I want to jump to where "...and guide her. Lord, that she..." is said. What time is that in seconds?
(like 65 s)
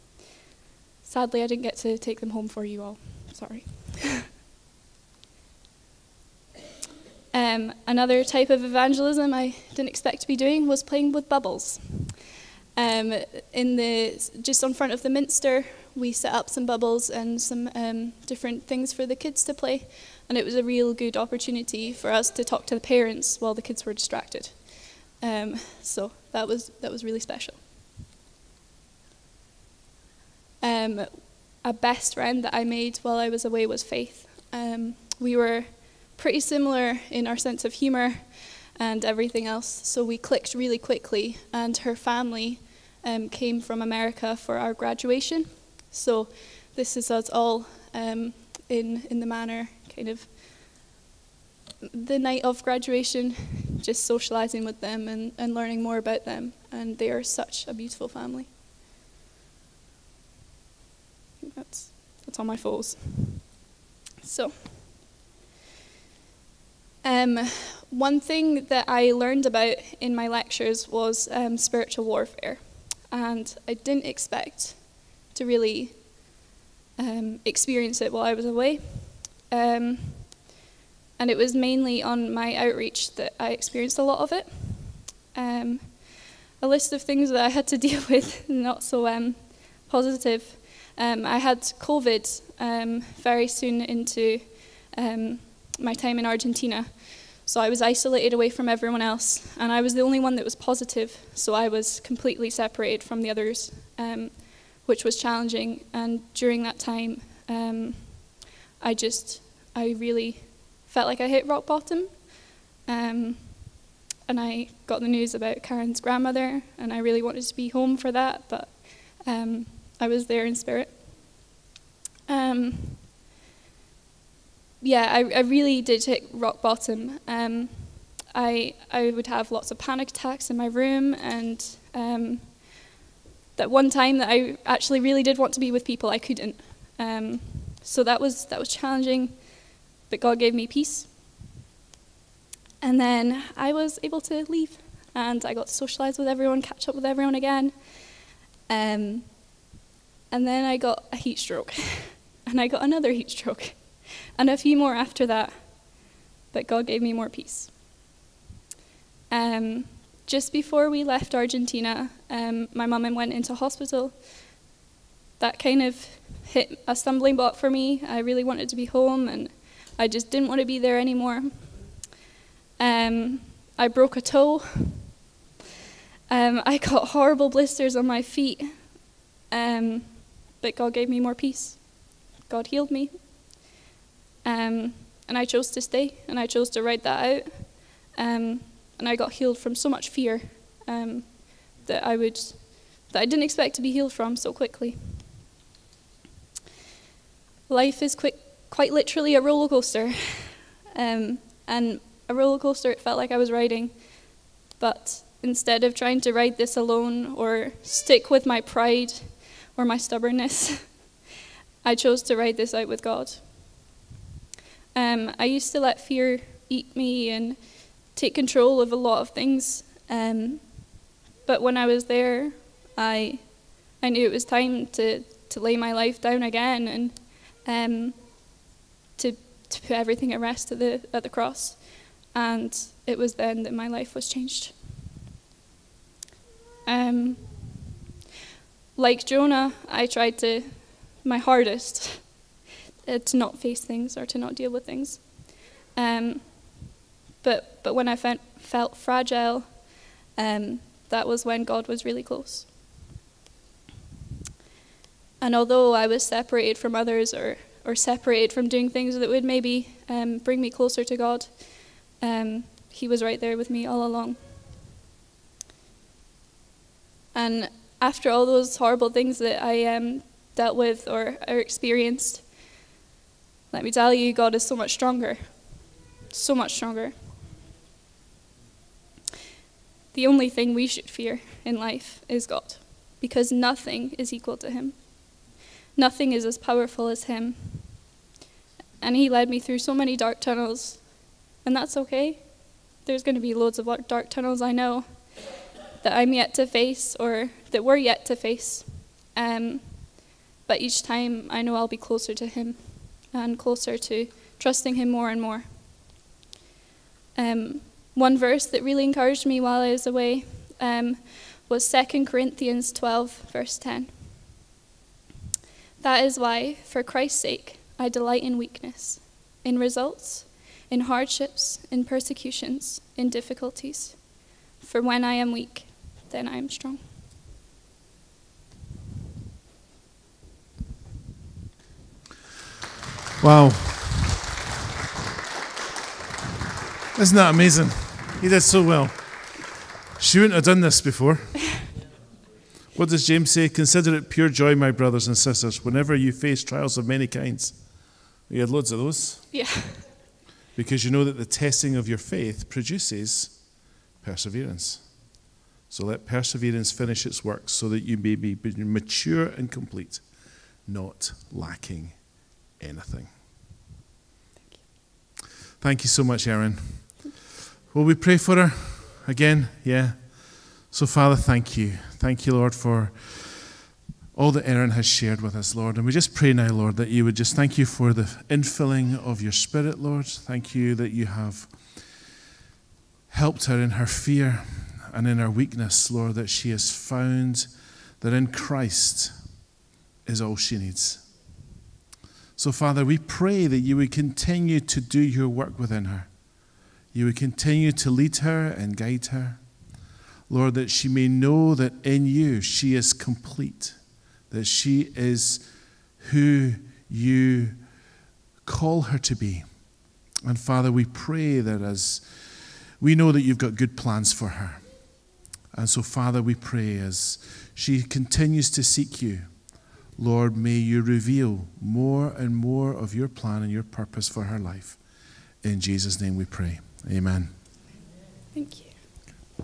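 398 s.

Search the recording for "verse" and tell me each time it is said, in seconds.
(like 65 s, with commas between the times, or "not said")
308 s, 313 s.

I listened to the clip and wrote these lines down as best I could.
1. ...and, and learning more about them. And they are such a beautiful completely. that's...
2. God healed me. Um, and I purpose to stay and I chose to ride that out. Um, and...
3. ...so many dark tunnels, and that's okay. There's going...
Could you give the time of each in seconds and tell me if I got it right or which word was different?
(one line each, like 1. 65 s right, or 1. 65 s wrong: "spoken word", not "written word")
1. 55 s wrong: "family", not "completely"
2. 182 s wrong: "chose", not "purpose"
3. 289 s right.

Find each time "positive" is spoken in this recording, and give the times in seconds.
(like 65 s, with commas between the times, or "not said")
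89 s, 100 s.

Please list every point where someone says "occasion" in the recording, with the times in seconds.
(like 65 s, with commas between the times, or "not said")
not said.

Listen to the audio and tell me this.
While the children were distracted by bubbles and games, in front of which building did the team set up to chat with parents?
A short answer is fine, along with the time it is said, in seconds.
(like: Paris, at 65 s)
the Minster, at 15 s.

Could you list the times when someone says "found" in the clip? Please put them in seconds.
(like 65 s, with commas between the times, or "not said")
386 s.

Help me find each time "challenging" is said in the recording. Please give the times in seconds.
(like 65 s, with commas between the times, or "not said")
105 s, 138 s.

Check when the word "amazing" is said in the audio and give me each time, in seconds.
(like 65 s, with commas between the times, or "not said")
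337 s.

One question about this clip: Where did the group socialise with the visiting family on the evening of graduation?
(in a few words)
the manor.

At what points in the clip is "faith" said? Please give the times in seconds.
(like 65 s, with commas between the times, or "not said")
33 s, 352 s.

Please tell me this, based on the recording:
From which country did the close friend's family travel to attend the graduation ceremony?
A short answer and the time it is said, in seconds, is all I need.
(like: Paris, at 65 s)
America, at 43 s.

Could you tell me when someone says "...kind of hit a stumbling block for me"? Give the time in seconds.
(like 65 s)
165 s.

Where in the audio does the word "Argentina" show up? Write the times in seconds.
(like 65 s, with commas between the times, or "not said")
96 s, 161 s.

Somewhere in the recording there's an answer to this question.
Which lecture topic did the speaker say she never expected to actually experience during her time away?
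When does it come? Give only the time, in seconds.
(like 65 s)
71 s.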